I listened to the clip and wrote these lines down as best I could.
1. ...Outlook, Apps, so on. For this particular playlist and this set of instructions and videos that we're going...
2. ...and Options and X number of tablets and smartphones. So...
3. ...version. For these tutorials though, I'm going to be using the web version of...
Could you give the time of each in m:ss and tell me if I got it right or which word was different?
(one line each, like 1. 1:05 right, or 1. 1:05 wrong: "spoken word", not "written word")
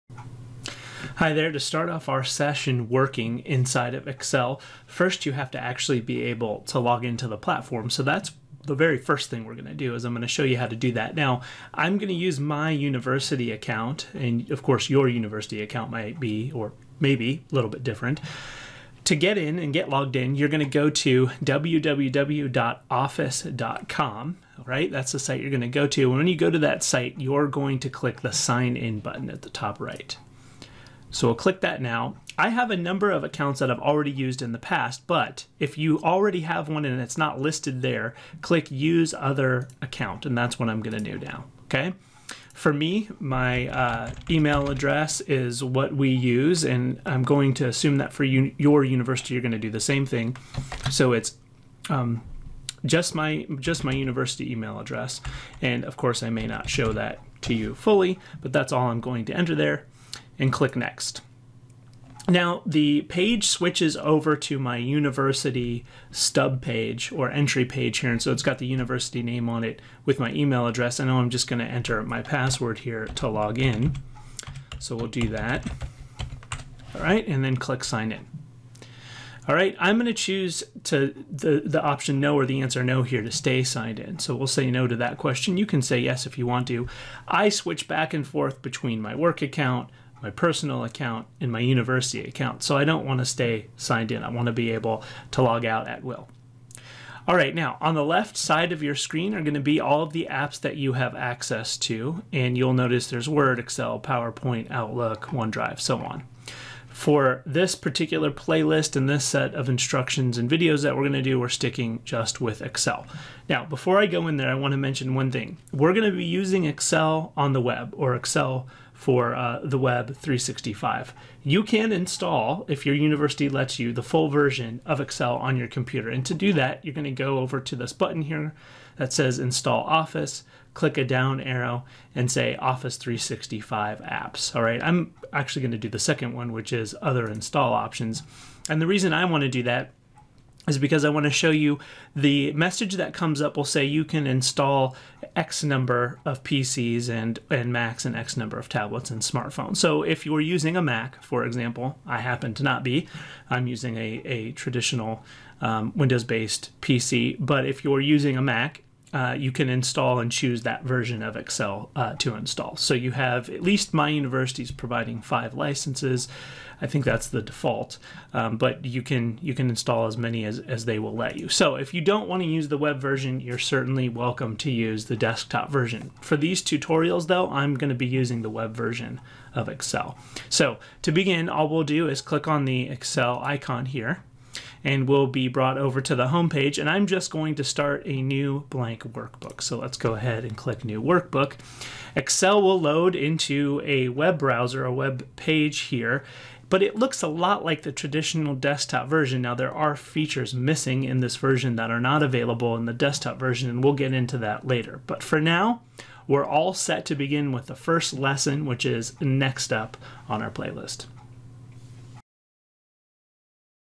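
1. 1:44 wrong: "OneDrive", not "Apps"
2. 2:27 wrong: "Macs", not "Options"
3. 2:55 right.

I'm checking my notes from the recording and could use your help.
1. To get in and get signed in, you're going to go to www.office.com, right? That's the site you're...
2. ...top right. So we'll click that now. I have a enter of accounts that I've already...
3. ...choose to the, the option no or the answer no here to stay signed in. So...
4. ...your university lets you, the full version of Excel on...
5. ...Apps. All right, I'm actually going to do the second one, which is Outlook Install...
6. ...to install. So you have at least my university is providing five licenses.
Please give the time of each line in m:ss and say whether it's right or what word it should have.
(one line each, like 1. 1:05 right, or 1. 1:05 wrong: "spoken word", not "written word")
1. 0:19 wrong: "logged", not "signed"
2. 0:29 wrong: "number", not "enter"
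3. 1:20 right
4. 2:02 right
5. 2:14 wrong: "Other", not "Outlook"
6. 2:42 right.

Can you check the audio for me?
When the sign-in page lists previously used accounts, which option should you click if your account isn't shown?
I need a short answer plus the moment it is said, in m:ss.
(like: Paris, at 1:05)
use other account, at 0:38.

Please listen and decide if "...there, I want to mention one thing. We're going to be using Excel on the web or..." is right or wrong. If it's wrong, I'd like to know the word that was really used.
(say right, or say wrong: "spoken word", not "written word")
right.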